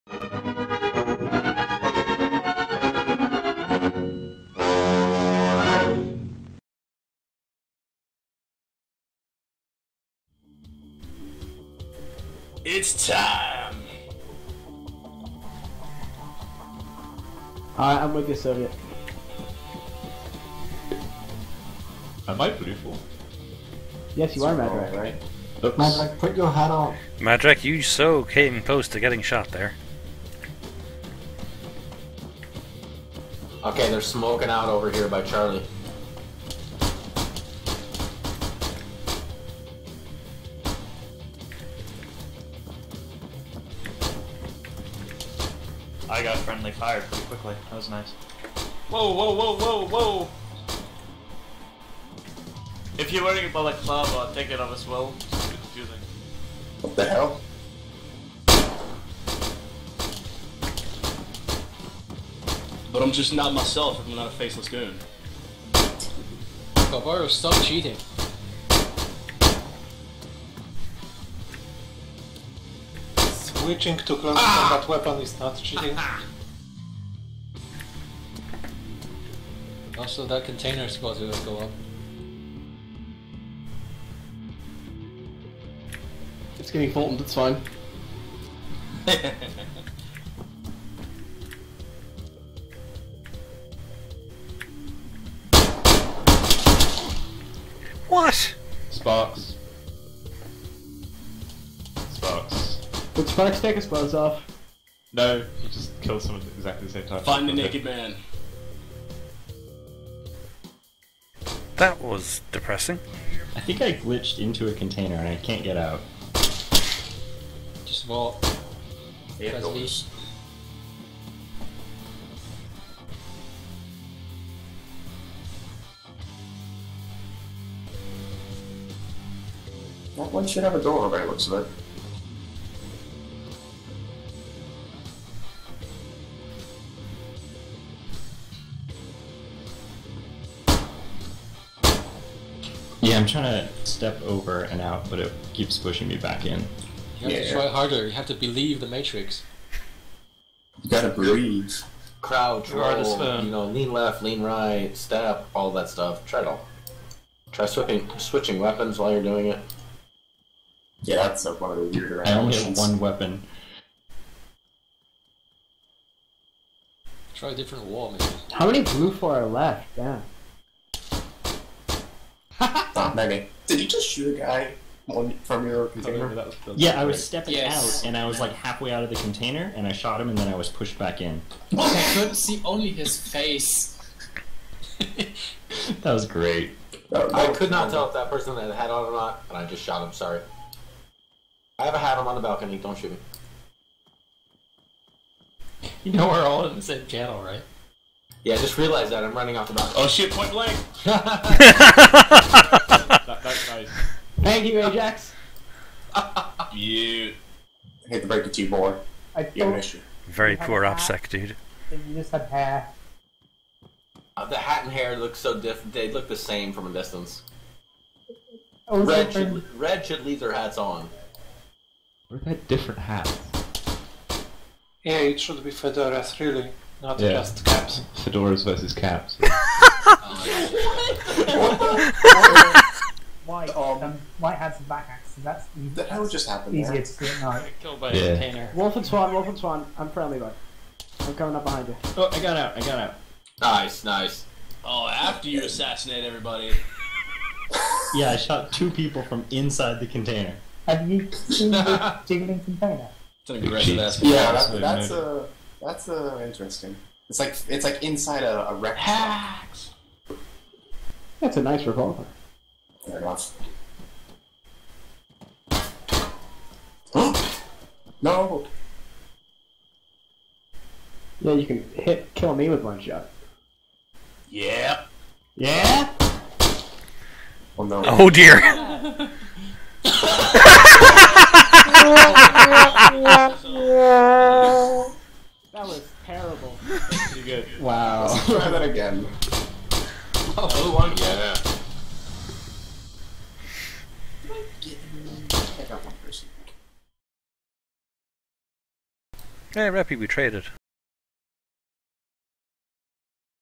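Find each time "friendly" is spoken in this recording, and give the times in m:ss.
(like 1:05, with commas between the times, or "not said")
0:46, 4:00.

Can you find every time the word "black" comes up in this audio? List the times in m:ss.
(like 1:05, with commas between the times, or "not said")
3:54.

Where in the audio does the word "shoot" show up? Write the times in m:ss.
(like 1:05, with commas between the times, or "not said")
2:54, 3:12.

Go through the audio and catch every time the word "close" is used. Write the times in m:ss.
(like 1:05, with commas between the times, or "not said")
0:28, 1:14.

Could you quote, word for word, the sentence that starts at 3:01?
I couldn't see only his face.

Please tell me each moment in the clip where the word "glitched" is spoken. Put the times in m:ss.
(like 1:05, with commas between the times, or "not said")
1:53.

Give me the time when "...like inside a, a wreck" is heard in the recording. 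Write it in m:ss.
4:17.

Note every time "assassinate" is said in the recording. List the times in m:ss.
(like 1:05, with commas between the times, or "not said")
4:05.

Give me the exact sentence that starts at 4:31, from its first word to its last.
Yeah, you can hit kill me with one shot.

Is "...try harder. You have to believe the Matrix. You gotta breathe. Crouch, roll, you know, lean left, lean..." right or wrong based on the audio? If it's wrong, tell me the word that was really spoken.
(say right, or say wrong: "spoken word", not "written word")
right.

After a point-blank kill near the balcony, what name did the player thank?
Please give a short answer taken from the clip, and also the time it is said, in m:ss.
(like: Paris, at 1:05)
Ajax, at 3:24.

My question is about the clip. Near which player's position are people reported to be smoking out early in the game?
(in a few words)
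Charlie.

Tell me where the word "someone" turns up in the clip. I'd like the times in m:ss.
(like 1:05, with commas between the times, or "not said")
1:46.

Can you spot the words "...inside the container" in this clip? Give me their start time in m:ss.
4:09.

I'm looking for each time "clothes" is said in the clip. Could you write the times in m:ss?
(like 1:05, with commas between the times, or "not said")
1:43.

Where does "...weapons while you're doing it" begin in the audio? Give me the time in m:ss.
2:38.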